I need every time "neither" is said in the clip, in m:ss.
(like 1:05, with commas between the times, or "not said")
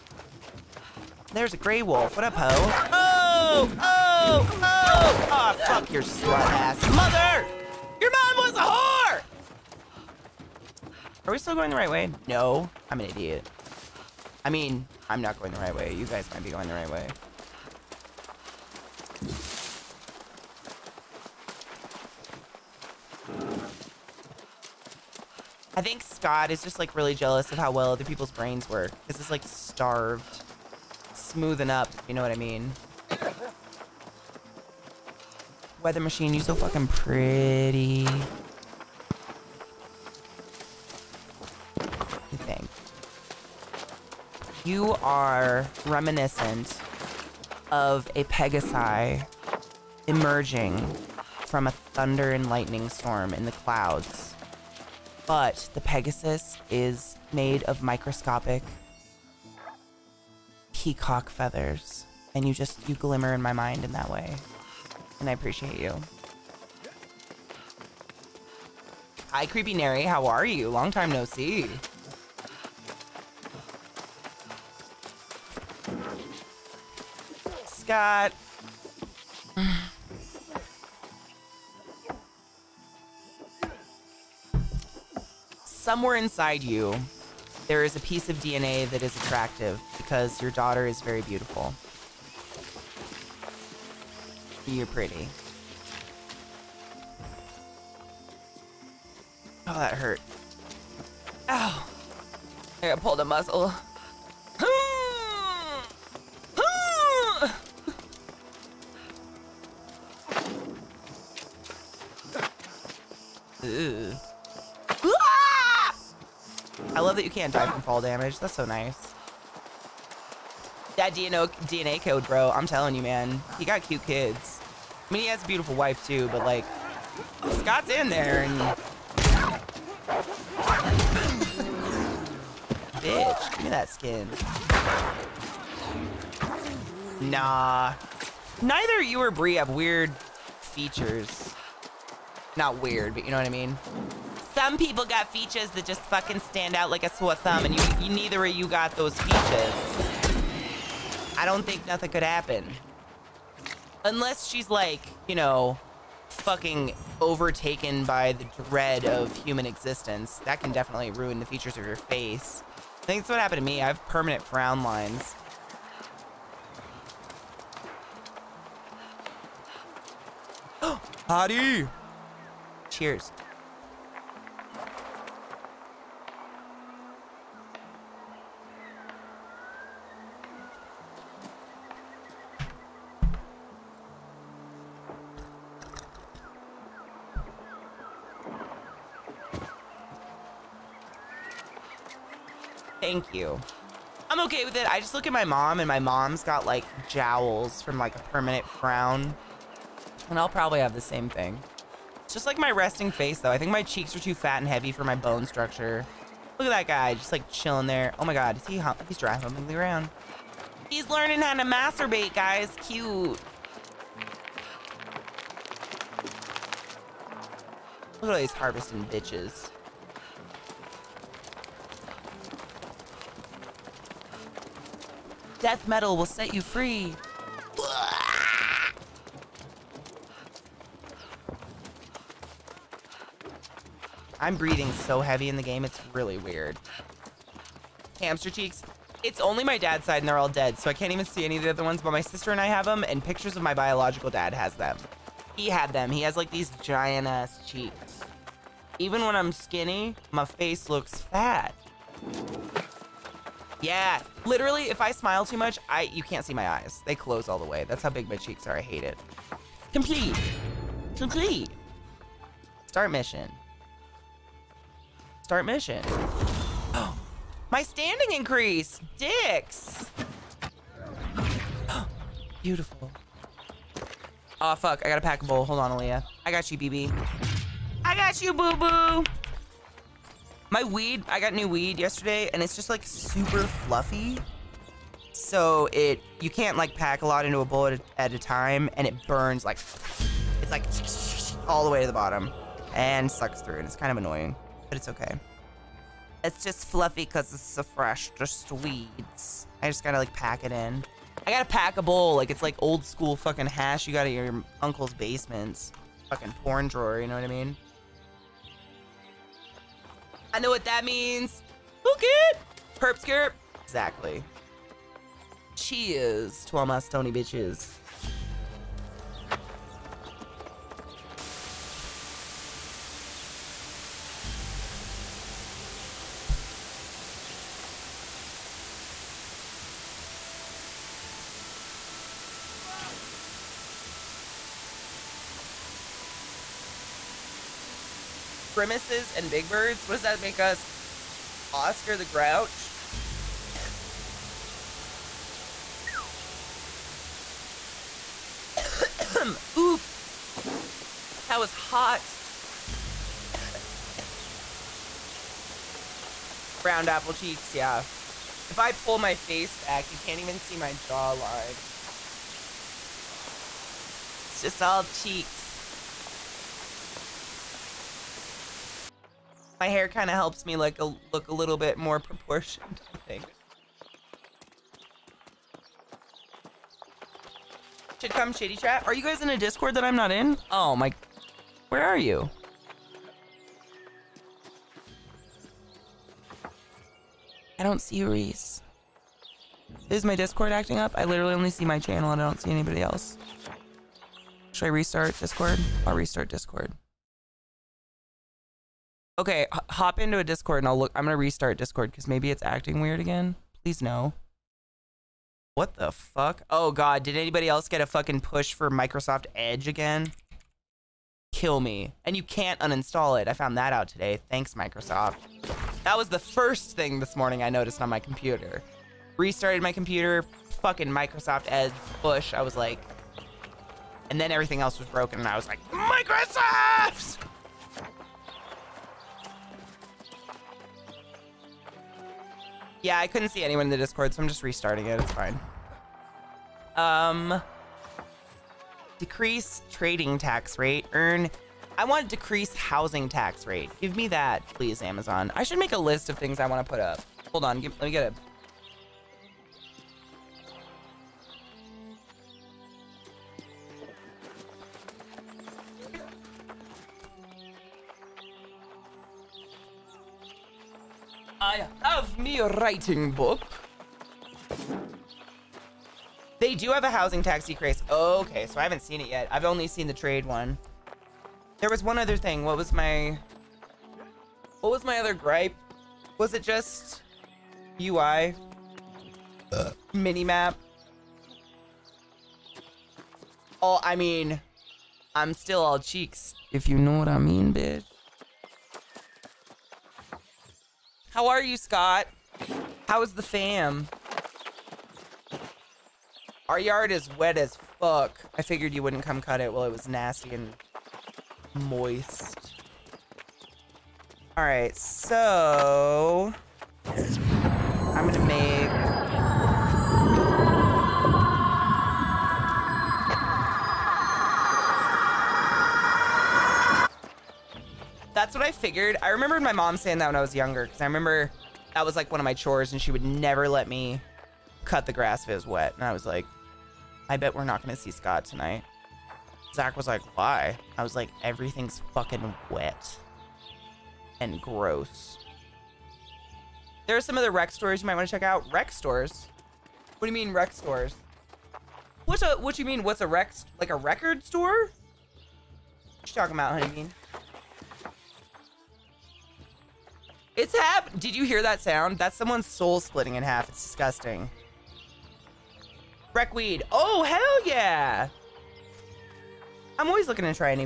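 2:18, 2:28.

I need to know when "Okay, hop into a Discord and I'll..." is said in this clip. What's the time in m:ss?
6:39.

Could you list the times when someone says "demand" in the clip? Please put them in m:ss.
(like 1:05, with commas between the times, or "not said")
not said.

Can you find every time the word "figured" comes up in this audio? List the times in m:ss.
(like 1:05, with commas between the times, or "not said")
8:18, 8:38.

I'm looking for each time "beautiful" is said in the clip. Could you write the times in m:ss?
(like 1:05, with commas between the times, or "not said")
1:31, 2:05, 4:32.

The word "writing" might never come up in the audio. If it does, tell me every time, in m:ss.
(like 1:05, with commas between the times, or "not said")
7:42.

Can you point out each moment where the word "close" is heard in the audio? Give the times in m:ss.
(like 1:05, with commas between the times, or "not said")
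4:17.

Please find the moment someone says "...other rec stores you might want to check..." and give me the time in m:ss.
8:57.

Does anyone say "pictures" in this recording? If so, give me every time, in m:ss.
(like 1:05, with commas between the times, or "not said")
4:03.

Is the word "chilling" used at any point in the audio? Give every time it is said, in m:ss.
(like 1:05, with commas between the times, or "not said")
3:27.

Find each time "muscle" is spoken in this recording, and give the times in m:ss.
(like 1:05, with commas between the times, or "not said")
1:43.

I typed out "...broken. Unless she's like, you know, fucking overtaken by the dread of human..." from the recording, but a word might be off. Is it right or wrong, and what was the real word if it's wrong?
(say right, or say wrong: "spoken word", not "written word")
wrong: "happen", not "broken".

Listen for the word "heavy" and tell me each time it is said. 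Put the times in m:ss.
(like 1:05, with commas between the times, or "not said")
3:24, 3:55.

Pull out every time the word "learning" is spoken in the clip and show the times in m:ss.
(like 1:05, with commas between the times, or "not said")
3:31.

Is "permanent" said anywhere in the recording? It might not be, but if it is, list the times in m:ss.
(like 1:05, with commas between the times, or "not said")
2:44, 3:18.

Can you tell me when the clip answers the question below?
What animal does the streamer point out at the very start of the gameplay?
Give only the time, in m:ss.
0:01.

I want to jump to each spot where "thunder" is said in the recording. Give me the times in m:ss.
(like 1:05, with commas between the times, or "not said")
0:51.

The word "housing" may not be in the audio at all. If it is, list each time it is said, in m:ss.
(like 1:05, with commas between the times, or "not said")
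7:22, 7:47.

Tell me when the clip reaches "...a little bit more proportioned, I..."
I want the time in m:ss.
6:11.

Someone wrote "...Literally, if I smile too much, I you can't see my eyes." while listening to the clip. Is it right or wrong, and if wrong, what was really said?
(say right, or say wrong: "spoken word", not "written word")
right.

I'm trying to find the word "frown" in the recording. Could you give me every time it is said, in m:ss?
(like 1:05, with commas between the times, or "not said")
2:44, 3:18.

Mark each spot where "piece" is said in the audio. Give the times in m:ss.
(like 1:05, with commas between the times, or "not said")
1:28.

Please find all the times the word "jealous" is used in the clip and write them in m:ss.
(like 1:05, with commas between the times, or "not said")
0:27.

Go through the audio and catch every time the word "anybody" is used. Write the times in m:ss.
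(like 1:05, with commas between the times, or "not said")
6:32, 6:47.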